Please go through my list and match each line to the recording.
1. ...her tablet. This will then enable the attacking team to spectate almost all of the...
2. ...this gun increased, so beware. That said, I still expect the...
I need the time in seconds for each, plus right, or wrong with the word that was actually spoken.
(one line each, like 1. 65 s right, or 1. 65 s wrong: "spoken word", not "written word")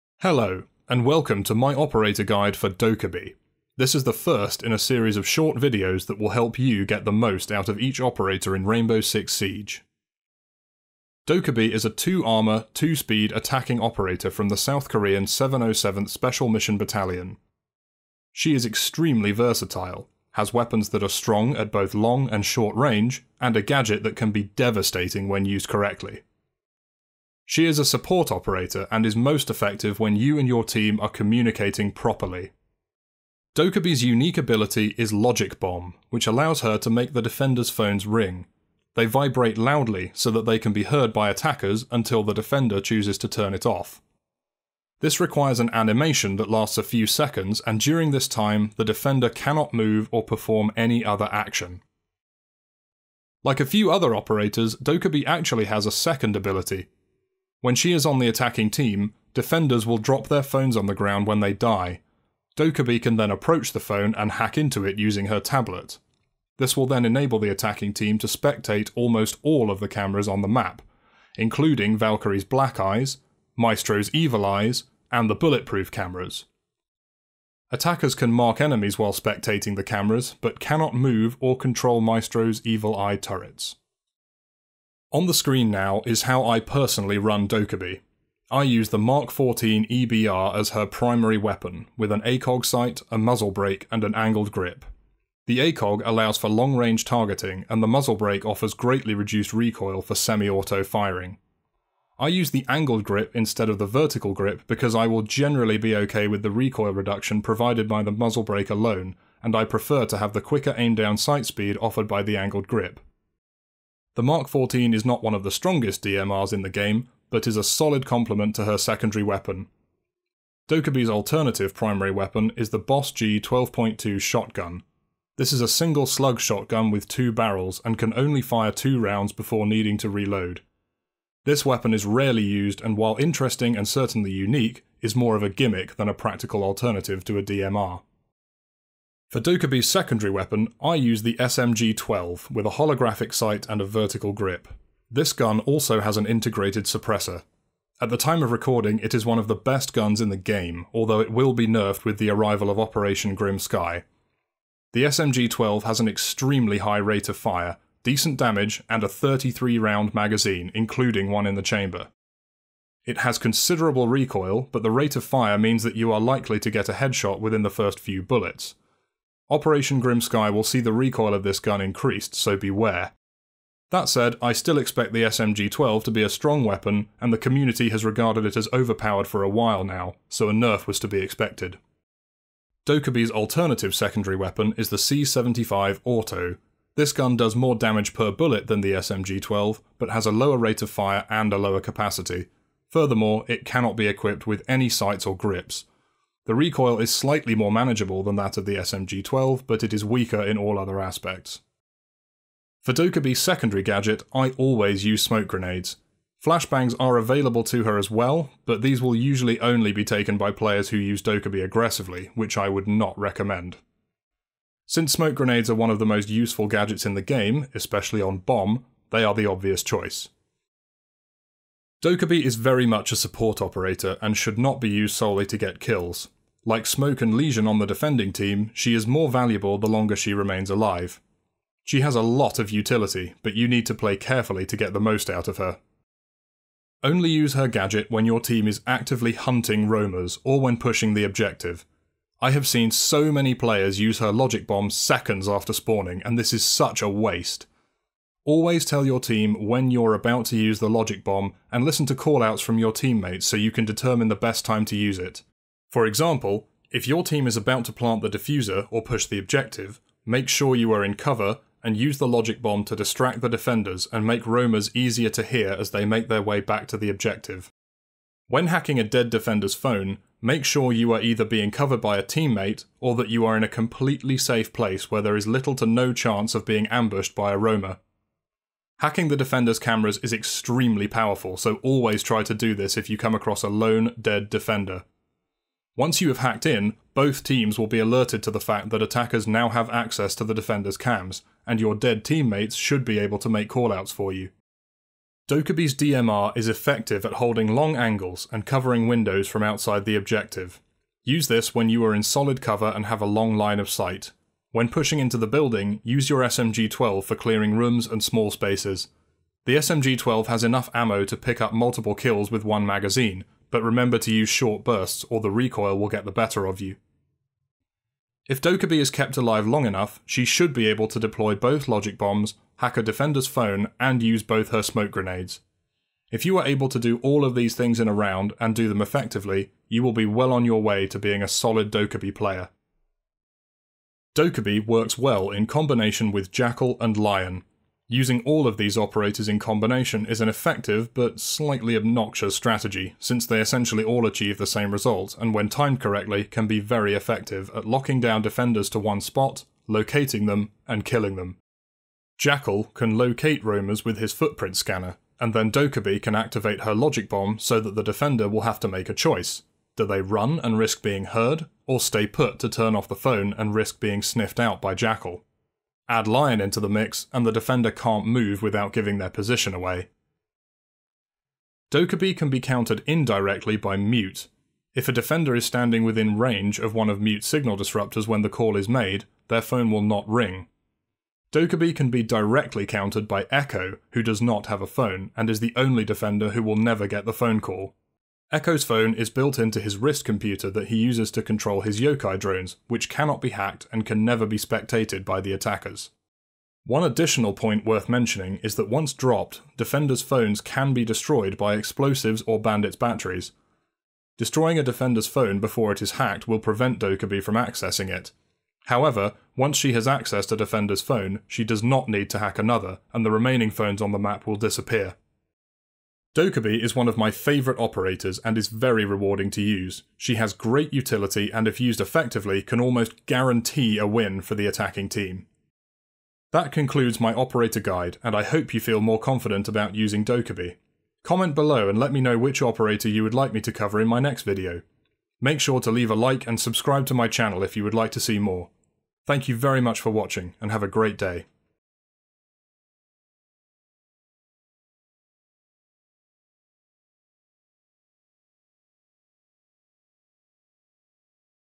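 1. 65 s right
2. 171 s right.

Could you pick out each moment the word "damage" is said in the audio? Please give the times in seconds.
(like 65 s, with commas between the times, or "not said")
158 s, 187 s.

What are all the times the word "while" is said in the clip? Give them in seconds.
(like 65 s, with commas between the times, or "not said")
78 s, 132 s, 179 s.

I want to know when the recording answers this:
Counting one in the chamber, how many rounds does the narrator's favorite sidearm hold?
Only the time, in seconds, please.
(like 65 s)
159 s.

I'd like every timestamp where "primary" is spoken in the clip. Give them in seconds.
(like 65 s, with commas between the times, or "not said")
90 s, 121 s.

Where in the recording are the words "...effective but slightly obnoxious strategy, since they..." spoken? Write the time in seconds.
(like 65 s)
340 s.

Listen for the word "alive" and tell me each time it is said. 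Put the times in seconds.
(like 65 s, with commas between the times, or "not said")
230 s, 319 s.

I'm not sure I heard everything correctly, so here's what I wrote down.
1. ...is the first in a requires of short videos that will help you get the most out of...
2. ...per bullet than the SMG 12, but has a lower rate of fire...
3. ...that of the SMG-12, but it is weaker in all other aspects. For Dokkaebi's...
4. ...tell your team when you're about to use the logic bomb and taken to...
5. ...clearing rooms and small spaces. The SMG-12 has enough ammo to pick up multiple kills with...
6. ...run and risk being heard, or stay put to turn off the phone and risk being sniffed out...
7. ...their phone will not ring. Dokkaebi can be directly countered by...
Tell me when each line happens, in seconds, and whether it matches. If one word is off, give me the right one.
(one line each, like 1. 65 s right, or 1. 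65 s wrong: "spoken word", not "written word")
1. 3 s wrong: "series", not "requires"
2. 188 s right
3. 198 s right
4. 248 s wrong: "listen", not "taken"
5. 307 s right
6. 360 s right
7. 379 s right.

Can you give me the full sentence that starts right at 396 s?
One additional point worth mentioning is that once dropped, defenders' phones can be destroyed by explosives or bandits' batteries.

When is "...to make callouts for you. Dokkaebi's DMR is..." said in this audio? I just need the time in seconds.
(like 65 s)
293 s.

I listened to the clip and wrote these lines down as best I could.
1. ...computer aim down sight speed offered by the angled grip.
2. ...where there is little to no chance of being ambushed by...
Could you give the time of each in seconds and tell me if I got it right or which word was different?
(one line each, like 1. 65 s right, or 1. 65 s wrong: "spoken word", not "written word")
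1. 110 s wrong: "quicker", not "computer"
2. 275 s right.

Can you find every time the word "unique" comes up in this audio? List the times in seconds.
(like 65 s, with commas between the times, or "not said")
34 s, 134 s.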